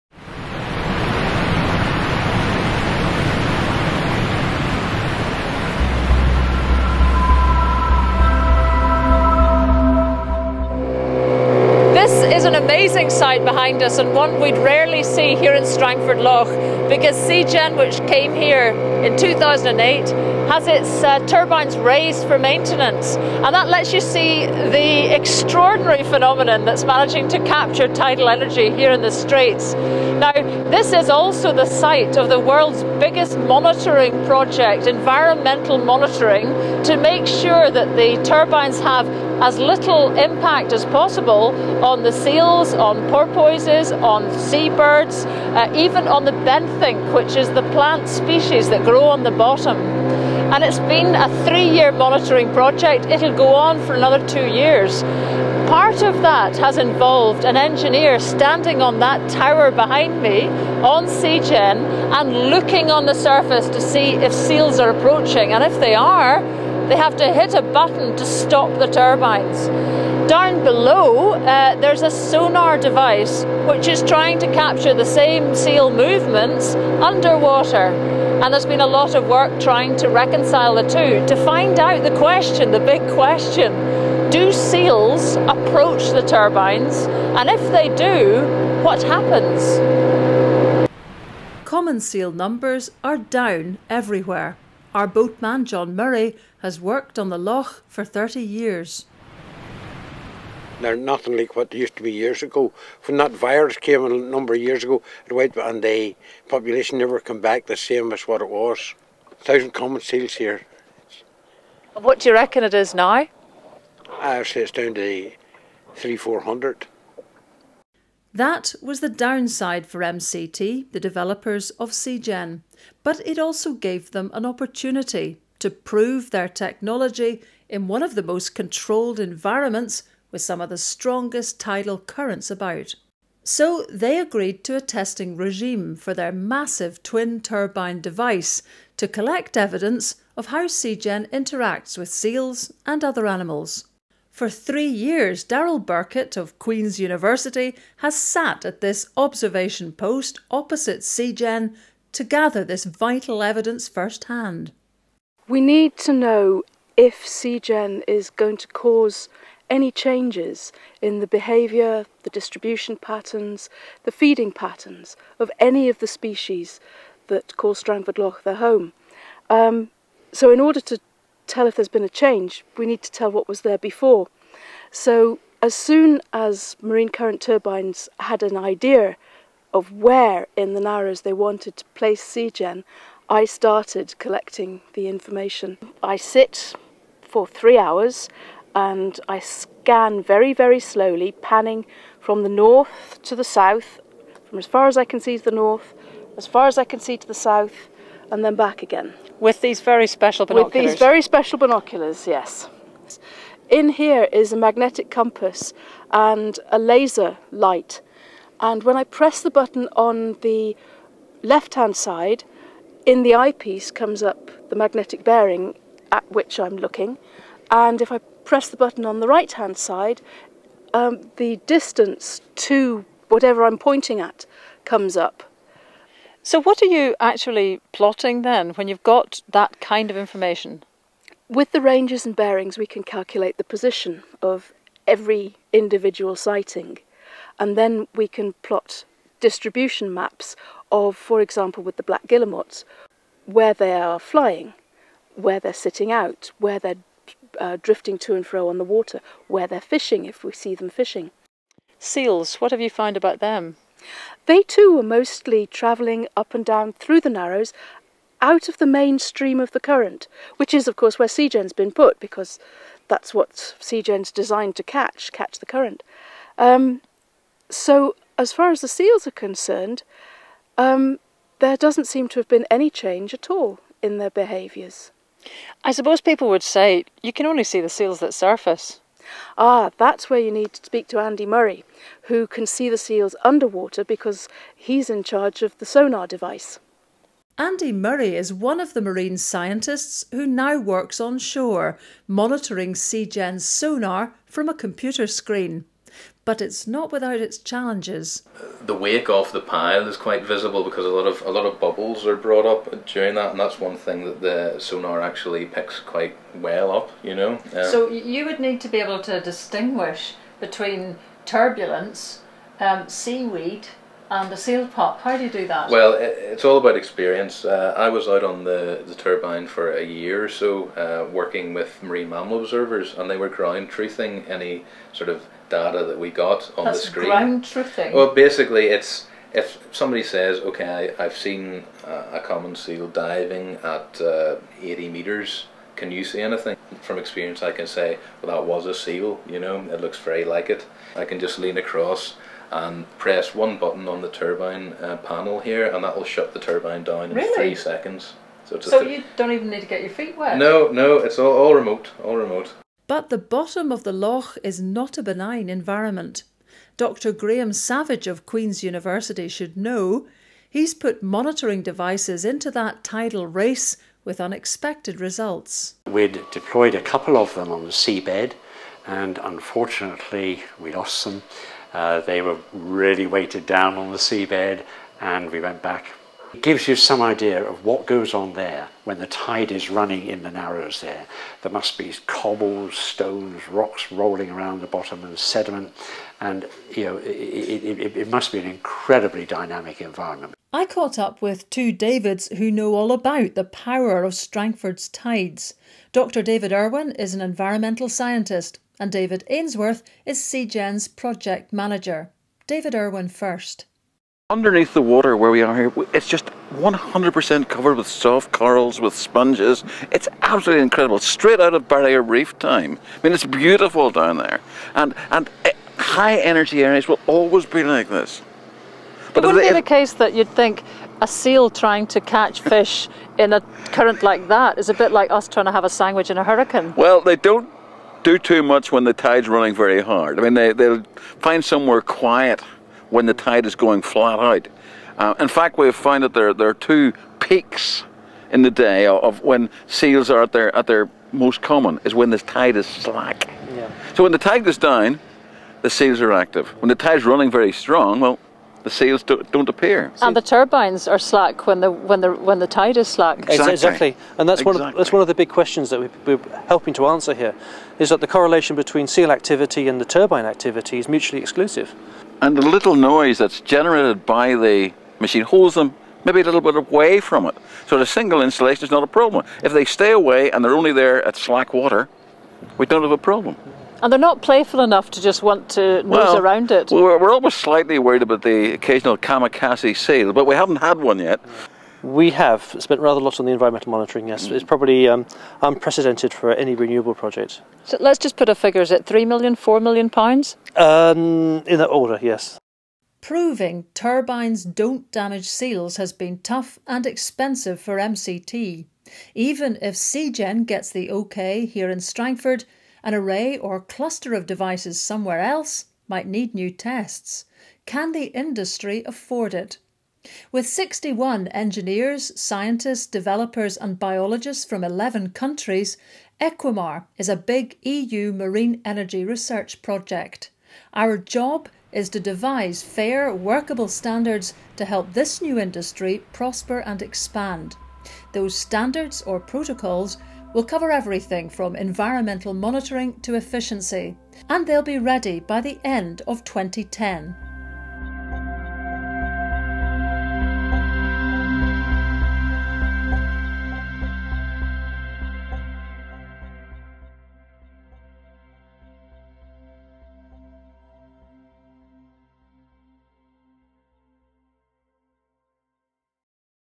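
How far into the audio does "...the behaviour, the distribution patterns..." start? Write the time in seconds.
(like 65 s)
161 s.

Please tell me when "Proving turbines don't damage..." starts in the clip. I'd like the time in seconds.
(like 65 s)
493 s.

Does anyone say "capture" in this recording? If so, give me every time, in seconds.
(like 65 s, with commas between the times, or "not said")
27 s, 74 s.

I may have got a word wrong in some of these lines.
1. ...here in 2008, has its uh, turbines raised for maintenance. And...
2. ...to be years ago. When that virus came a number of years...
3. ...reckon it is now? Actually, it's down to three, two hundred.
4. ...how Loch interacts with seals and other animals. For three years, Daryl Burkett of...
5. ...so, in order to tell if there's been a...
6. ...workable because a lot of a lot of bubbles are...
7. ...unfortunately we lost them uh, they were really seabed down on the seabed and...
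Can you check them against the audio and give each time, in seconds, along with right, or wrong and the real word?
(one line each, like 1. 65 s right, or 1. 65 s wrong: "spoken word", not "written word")
1. 18 s right
2. 101 s right
3. 112 s wrong: "four", not "two"
4. 140 s wrong: "SeaGen", not "Loch"
5. 170 s right
6. 300 s wrong: "visible", not "workable"
7. 369 s wrong: "weighted", not "seabed".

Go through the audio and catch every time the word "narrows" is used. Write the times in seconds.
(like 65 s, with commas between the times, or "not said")
180 s, 257 s, 380 s.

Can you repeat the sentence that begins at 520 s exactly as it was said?
Our job is to devise fair, workable standards to help this new industry prosper and expand.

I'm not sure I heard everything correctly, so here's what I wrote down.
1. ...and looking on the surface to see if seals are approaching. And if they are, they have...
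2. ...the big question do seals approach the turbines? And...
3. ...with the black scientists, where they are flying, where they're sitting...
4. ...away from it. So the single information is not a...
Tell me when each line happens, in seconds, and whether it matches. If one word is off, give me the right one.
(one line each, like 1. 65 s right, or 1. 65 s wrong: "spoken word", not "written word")
1. 62 s right
2. 82 s right
3. 241 s wrong: "guillemots", not "scientists"
4. 466 s wrong: "installation", not "information".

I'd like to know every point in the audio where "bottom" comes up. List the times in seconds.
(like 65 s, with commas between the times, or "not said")
49 s, 353 s, 384 s.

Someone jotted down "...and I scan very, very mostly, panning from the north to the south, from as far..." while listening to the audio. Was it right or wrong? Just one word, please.
wrong.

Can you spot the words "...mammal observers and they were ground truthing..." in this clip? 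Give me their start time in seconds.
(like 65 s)
322 s.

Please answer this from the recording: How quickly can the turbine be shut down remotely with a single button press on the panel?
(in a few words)
3 seconds.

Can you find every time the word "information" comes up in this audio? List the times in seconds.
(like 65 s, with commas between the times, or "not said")
185 s, 230 s.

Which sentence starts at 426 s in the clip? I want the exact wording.
Well, they don't do too much when the tide's running very hard.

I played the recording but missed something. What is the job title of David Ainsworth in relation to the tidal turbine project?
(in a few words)
Project manager.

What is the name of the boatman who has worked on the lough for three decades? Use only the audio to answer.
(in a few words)
John Murray.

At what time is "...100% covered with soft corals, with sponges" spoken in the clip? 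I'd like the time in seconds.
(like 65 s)
406 s.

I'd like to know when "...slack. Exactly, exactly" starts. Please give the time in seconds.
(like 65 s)
453 s.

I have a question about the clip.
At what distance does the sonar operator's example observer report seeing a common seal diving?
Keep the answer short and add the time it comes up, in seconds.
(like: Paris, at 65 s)
80 metres, at 334 s.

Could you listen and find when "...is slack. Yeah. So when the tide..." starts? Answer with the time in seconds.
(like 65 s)
442 s.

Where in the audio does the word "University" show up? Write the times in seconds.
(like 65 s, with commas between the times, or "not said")
146 s, 358 s.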